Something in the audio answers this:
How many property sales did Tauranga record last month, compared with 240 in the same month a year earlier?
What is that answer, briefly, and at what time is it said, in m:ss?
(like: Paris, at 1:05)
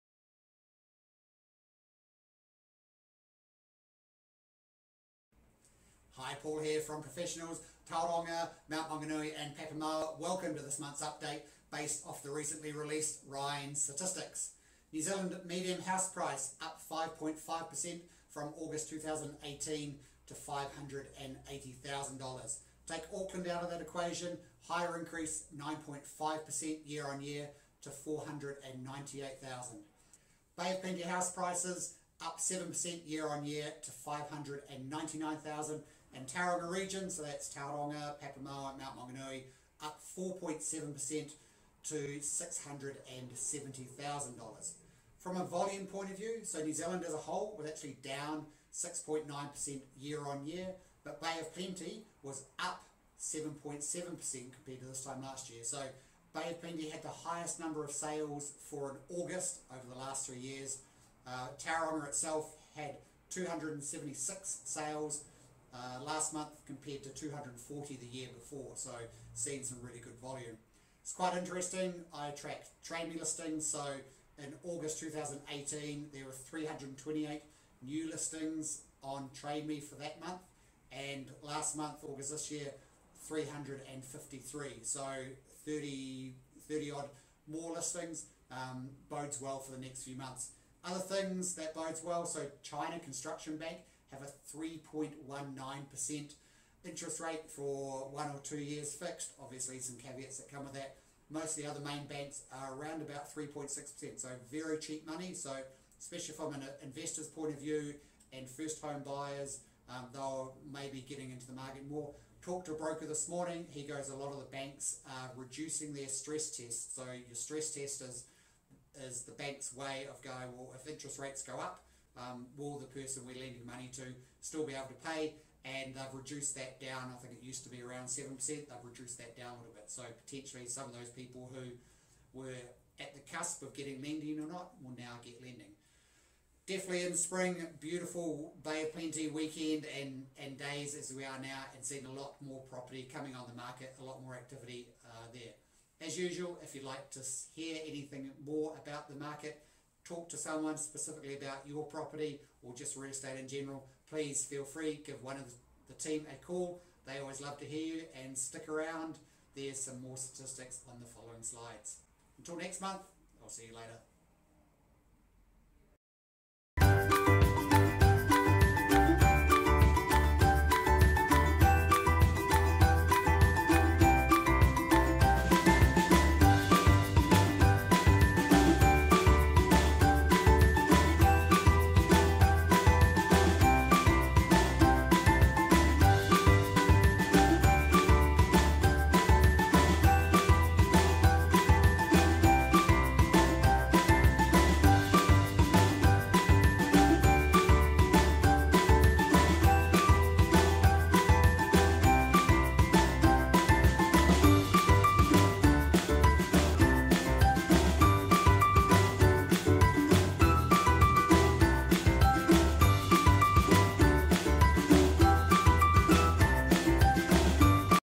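276, at 1:03.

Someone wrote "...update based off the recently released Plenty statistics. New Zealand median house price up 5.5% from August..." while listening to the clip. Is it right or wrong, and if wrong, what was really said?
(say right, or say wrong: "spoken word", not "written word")
wrong: "REINZ", not "Plenty".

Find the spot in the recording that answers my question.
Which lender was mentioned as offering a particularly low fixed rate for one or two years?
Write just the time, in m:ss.
1:32.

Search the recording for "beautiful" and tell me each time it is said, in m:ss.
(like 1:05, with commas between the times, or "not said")
2:17.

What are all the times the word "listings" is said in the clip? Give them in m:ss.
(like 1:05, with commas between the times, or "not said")
1:13, 1:18, 1:27.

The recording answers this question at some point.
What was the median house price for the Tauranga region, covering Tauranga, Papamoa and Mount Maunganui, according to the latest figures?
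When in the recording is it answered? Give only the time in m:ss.
0:41.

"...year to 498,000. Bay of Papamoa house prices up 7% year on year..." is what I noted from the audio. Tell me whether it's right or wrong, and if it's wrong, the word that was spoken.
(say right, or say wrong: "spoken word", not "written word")
wrong: "Plenty", not "Papamoa".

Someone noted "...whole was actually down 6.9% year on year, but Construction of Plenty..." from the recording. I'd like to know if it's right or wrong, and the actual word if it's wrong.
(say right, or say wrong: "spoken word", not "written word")
wrong: "Bay", not "Construction".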